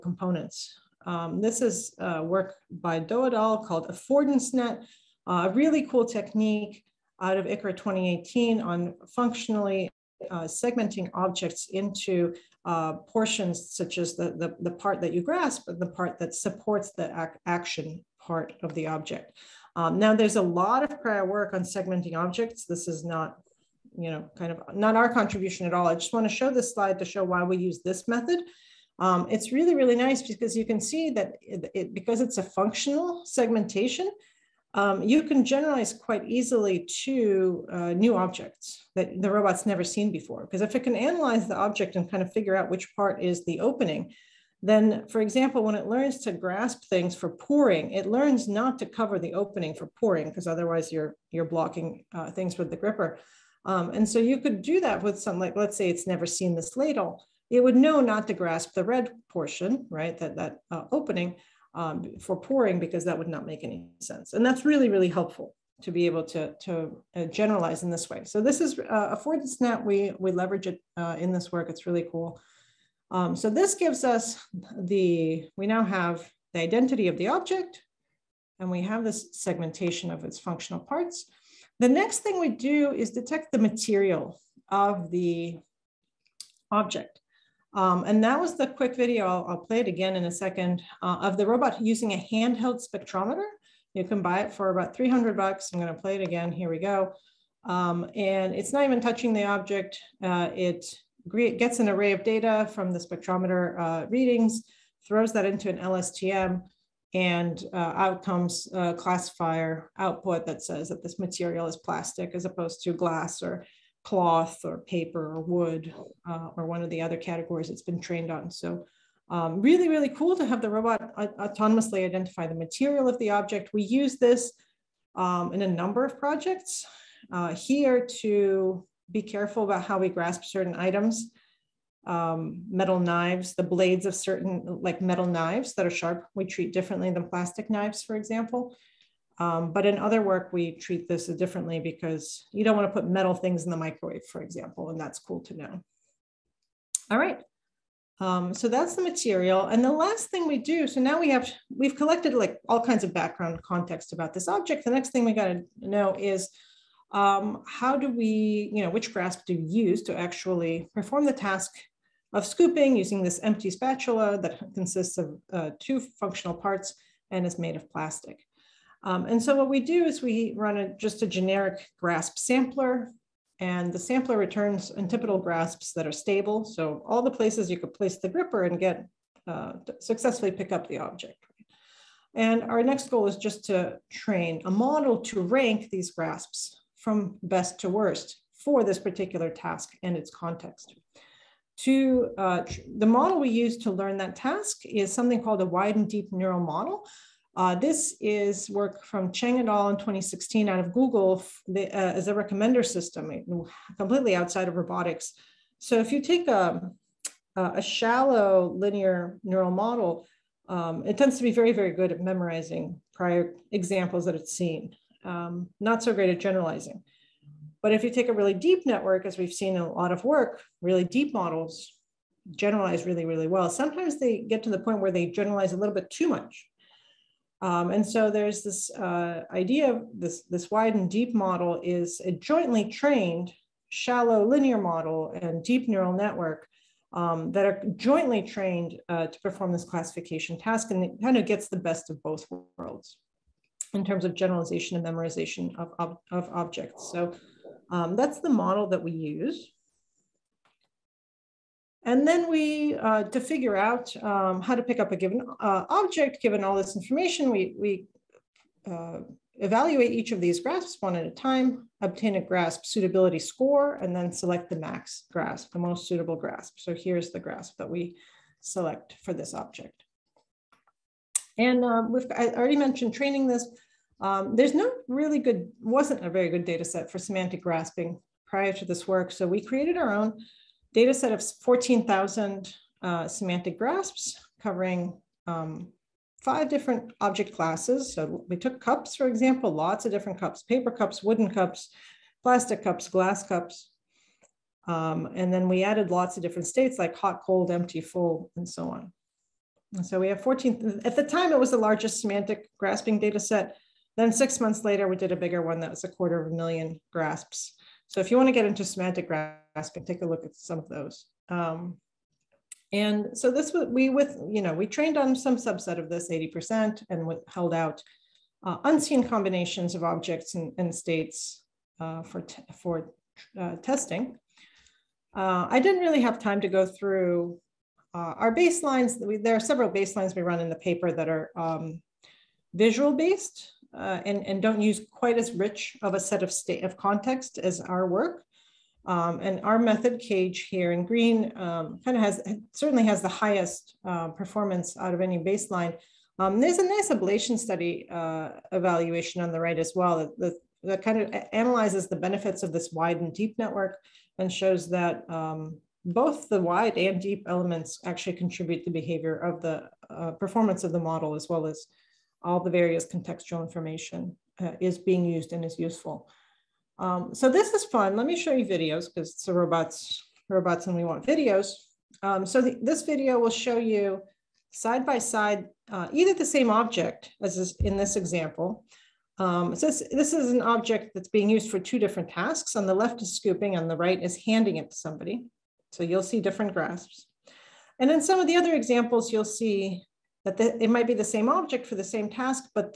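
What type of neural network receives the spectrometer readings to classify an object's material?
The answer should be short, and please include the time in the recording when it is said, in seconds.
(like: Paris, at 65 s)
LSTM, at 105 s.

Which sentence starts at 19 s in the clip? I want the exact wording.
Um, now there's a lot of prior work on segmenting objects.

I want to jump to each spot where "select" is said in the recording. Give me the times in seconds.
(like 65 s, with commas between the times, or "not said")
264 s, 268 s.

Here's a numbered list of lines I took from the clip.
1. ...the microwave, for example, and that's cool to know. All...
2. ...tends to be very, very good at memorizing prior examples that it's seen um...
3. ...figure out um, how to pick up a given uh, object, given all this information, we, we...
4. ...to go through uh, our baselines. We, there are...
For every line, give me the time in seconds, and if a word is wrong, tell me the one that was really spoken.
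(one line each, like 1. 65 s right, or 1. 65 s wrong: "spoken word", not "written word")
1. 143 s right
2. 211 s right
3. 253 s right
4. 326 s right.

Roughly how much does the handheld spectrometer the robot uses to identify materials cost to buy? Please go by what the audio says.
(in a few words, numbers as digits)
$300.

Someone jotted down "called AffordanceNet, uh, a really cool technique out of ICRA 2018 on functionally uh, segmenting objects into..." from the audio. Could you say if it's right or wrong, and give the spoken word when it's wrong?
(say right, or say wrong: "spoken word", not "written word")
right.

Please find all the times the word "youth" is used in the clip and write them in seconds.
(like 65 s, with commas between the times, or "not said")
not said.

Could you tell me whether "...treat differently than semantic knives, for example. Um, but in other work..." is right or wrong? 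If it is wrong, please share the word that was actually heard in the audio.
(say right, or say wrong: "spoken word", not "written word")
wrong: "plastic", not "semantic".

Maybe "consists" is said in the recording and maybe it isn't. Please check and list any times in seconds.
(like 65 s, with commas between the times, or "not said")
164 s.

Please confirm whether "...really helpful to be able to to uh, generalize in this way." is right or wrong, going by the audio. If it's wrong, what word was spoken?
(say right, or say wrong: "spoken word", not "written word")
right.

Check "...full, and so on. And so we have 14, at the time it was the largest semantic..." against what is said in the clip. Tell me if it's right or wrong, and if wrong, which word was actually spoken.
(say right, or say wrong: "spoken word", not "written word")
right.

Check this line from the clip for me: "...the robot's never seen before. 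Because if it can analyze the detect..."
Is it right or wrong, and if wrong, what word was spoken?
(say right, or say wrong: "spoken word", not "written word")
wrong: "object", not "detect".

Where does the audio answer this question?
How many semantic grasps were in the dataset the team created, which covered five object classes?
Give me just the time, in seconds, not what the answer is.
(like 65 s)
281 s.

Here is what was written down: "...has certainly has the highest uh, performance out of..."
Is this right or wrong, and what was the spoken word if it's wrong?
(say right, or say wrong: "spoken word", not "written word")
right.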